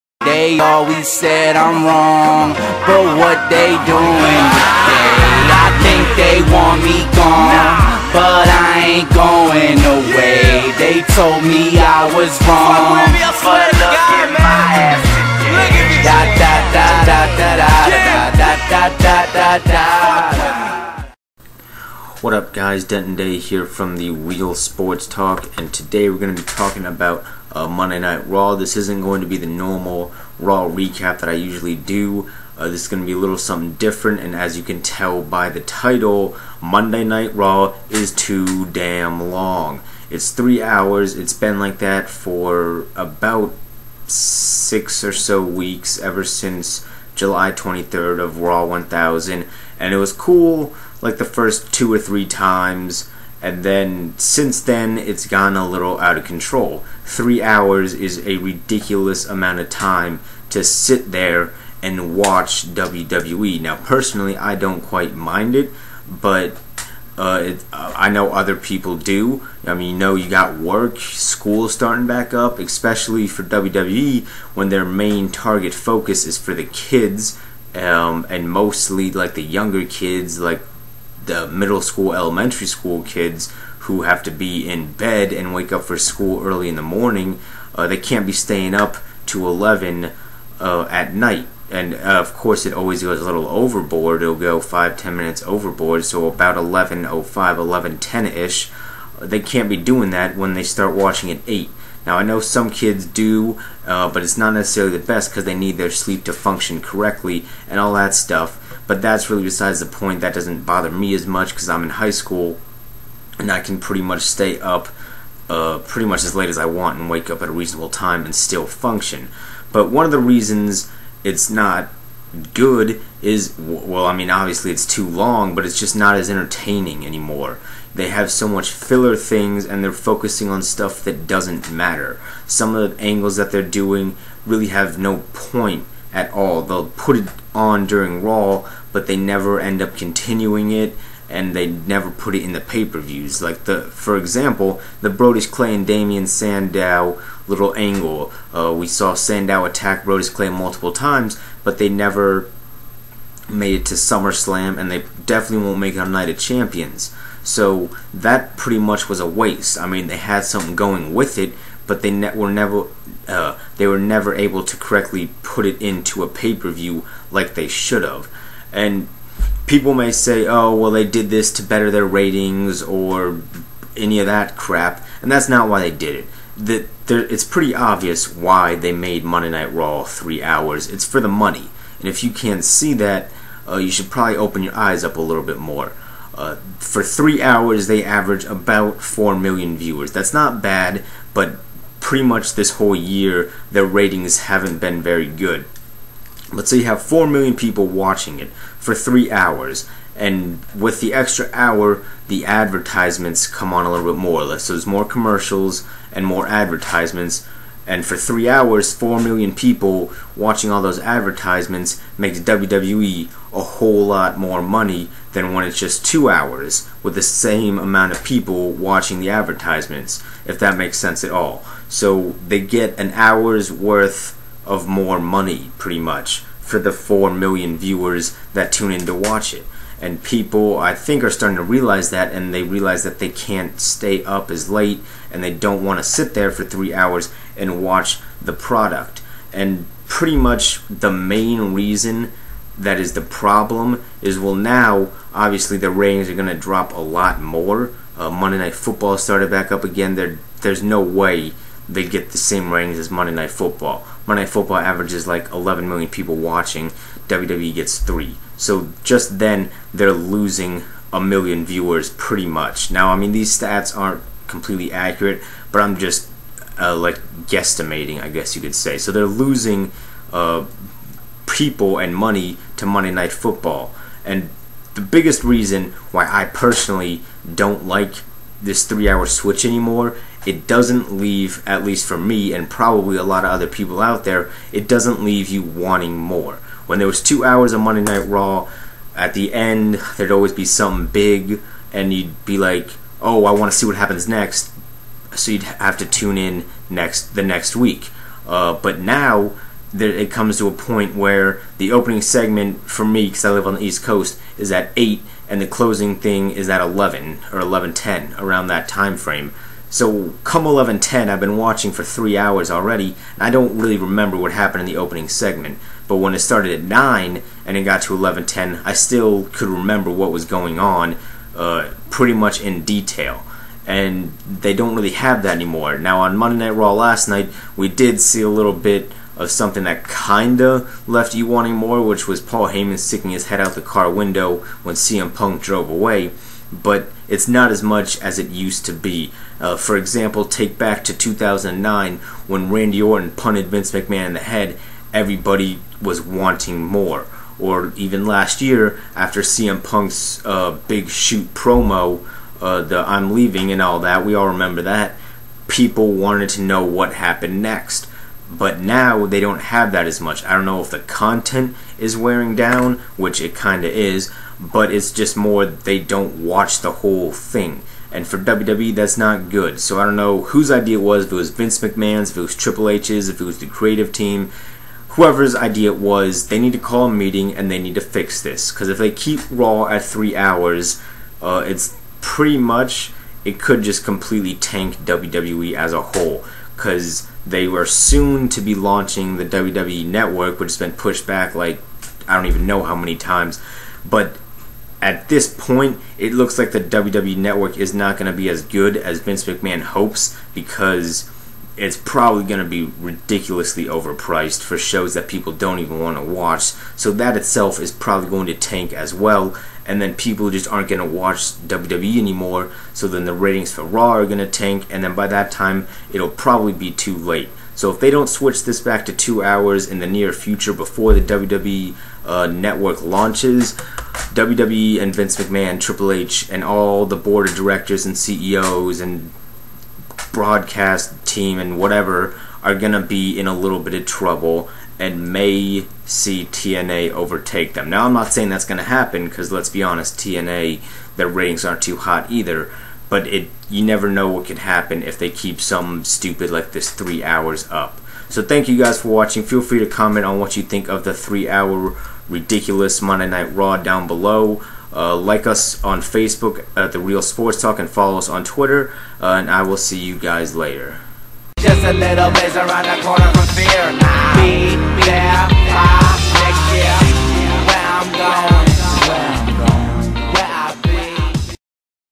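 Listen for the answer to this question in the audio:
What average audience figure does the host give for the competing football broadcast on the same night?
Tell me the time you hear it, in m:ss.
4:15.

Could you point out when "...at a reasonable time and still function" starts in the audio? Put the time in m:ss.
1:57.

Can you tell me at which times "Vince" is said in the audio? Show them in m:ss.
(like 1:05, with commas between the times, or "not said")
5:43, 6:11, 6:39, 7:05.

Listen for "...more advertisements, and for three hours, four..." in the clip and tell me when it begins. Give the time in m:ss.
3:26.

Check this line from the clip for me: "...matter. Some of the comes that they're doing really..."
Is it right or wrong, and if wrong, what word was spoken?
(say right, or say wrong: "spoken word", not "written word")
wrong: "angles", not "comes".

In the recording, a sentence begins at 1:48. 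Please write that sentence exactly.
But that's really besides the point.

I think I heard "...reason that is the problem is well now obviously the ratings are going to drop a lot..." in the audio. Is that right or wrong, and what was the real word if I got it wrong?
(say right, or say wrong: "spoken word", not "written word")
right.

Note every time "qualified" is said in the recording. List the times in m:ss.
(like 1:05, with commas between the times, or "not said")
not said.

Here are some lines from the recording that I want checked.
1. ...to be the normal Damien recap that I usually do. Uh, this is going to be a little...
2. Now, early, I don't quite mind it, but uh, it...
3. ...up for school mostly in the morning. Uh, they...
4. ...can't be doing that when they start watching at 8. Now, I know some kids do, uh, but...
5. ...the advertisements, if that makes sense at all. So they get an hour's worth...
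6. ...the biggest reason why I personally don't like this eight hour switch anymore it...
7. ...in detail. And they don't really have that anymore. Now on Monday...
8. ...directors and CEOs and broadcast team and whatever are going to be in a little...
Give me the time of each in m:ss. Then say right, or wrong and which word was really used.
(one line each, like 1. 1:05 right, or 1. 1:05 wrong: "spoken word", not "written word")
1. 0:29 wrong: "Raw", not "Damien"
2. 1:03 wrong: "personally", not "early"
3. 1:25 wrong: "early", not "mostly"
4. 1:39 right
5. 3:39 right
6. 4:34 wrong: "three", not "eight"
7. 5:22 right
8. 7:07 right.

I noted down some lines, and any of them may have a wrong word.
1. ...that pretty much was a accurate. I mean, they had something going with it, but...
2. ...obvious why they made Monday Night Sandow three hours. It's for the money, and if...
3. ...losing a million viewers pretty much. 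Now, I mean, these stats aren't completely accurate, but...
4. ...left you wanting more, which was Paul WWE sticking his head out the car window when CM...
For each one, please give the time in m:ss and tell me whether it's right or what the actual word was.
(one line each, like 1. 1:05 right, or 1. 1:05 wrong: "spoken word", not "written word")
1. 2:38 wrong: "waste", not "accurate"
2. 2:57 wrong: "Raw", not "Sandow"
3. 4:20 right
4. 5:31 wrong: "Heyman", not "WWE".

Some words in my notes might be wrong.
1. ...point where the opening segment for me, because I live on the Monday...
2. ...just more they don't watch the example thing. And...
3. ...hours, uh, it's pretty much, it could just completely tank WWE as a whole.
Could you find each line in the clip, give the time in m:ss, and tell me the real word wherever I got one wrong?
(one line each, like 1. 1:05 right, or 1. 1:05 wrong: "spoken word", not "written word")
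1. 5:00 wrong: "East", not "Monday"
2. 6:05 wrong: "whole", not "example"
3. 6:20 right.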